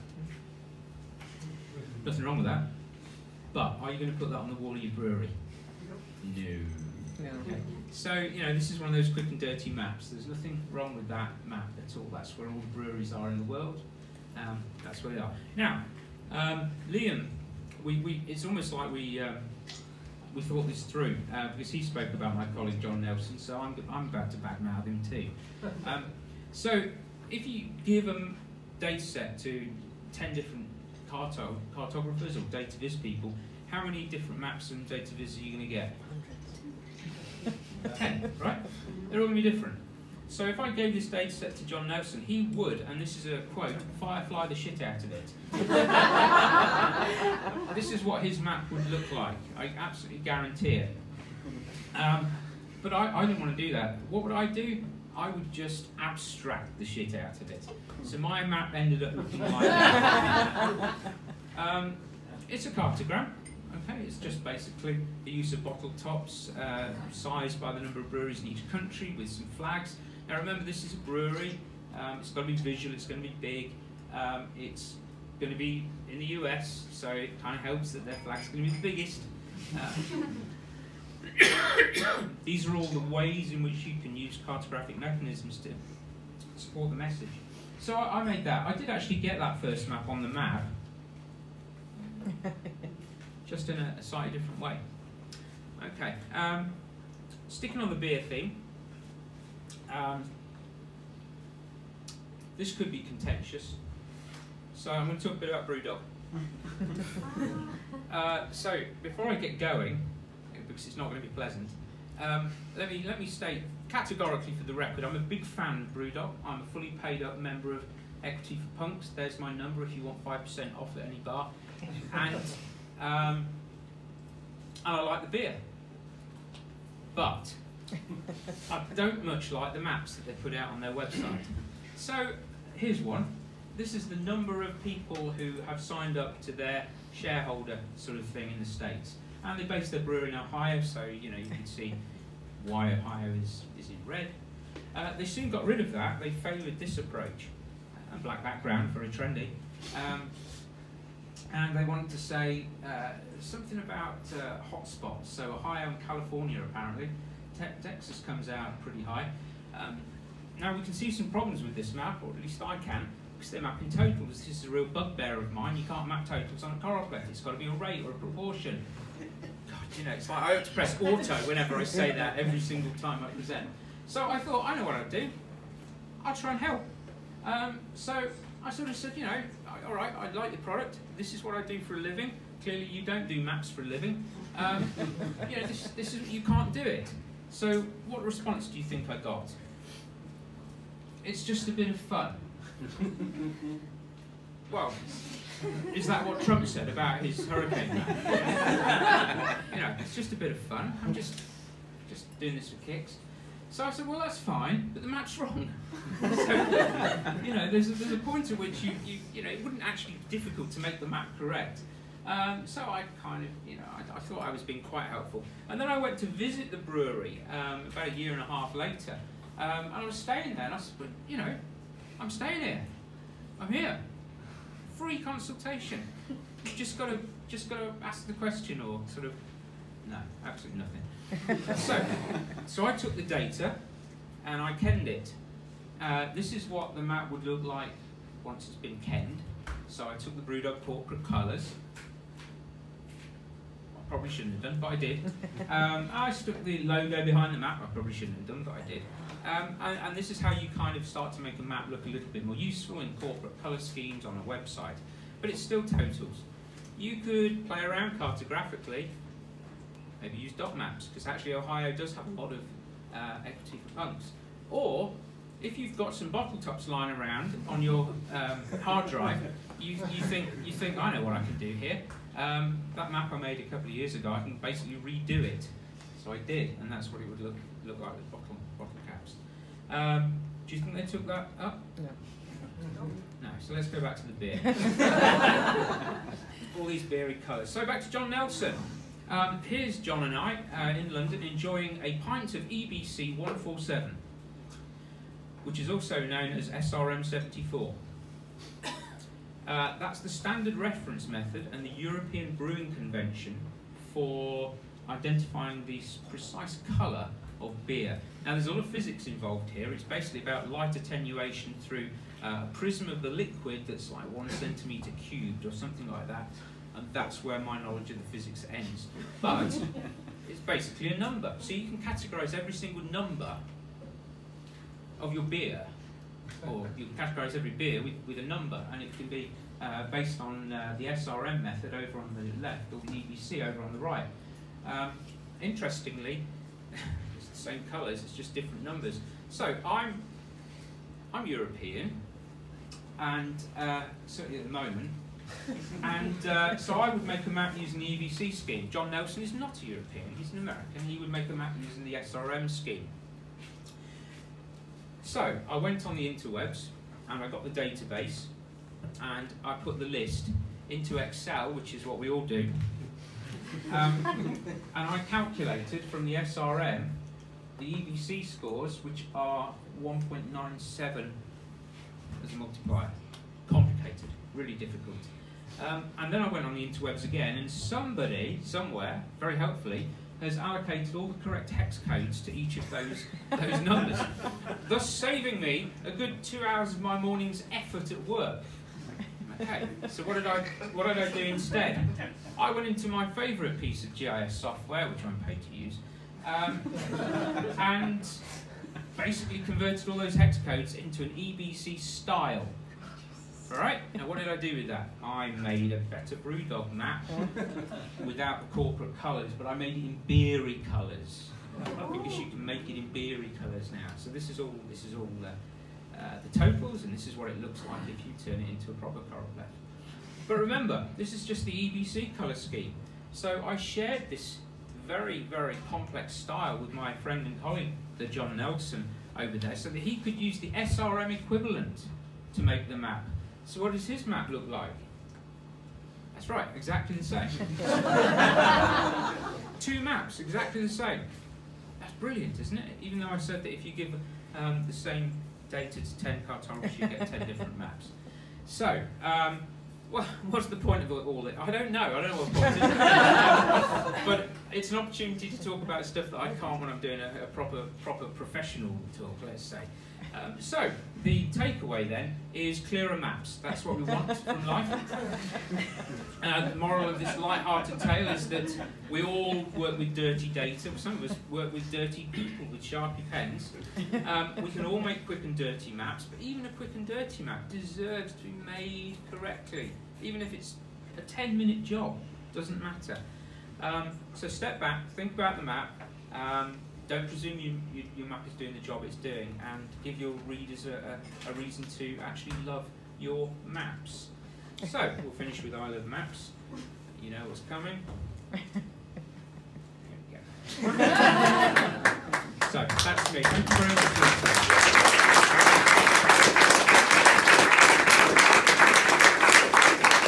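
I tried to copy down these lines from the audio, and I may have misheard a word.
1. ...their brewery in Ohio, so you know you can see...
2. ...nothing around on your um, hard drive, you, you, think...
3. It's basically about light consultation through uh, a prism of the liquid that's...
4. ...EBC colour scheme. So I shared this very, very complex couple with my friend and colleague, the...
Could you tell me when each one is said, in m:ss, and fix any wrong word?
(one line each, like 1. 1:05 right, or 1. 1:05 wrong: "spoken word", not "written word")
1. 2:19 right
2. 4:26 wrong: "lying", not "nothing"
3. 5:09 wrong: "attenuation", not "consultation"
4. 7:01 wrong: "style", not "couple".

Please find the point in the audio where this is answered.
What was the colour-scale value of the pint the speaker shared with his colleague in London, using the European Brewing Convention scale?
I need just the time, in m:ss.
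4:52.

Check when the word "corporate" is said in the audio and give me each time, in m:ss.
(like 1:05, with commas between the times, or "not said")
4:00, 4:13, 6:48.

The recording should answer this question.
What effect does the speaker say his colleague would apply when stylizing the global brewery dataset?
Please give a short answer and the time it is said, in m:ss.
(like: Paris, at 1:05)
firefly, at 0:43.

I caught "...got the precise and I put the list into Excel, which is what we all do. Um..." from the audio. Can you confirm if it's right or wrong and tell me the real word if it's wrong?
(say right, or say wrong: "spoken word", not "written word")
wrong: "database", not "precise".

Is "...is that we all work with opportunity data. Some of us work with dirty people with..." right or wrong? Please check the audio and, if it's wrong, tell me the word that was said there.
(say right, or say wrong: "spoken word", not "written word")
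wrong: "dirty", not "opportunity".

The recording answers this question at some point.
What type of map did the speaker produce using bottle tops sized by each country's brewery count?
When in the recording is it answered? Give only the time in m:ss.
1:02.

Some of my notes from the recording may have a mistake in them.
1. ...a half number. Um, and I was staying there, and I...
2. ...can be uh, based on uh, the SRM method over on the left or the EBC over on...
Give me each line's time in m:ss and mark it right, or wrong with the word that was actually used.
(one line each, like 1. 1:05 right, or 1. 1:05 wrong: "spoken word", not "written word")
1. 3:38 wrong: "later", not "number"
2. 5:29 right.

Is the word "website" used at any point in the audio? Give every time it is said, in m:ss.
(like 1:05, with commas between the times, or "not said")
2:10, 4:14.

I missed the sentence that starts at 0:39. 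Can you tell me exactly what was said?
They're all going to be different.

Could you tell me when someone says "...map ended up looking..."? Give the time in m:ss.
0:58.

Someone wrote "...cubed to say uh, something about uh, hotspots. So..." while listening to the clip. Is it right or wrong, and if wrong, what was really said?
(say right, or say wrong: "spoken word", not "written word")
wrong: "wanted", not "cubed".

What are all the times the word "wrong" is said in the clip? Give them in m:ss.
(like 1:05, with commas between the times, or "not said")
0:02, 0:10, 3:25.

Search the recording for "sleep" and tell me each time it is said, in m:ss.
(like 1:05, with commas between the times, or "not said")
not said.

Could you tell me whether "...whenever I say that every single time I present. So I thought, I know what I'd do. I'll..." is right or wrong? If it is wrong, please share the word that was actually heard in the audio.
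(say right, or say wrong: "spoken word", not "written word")
right.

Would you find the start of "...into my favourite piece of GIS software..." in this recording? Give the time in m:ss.
6:32.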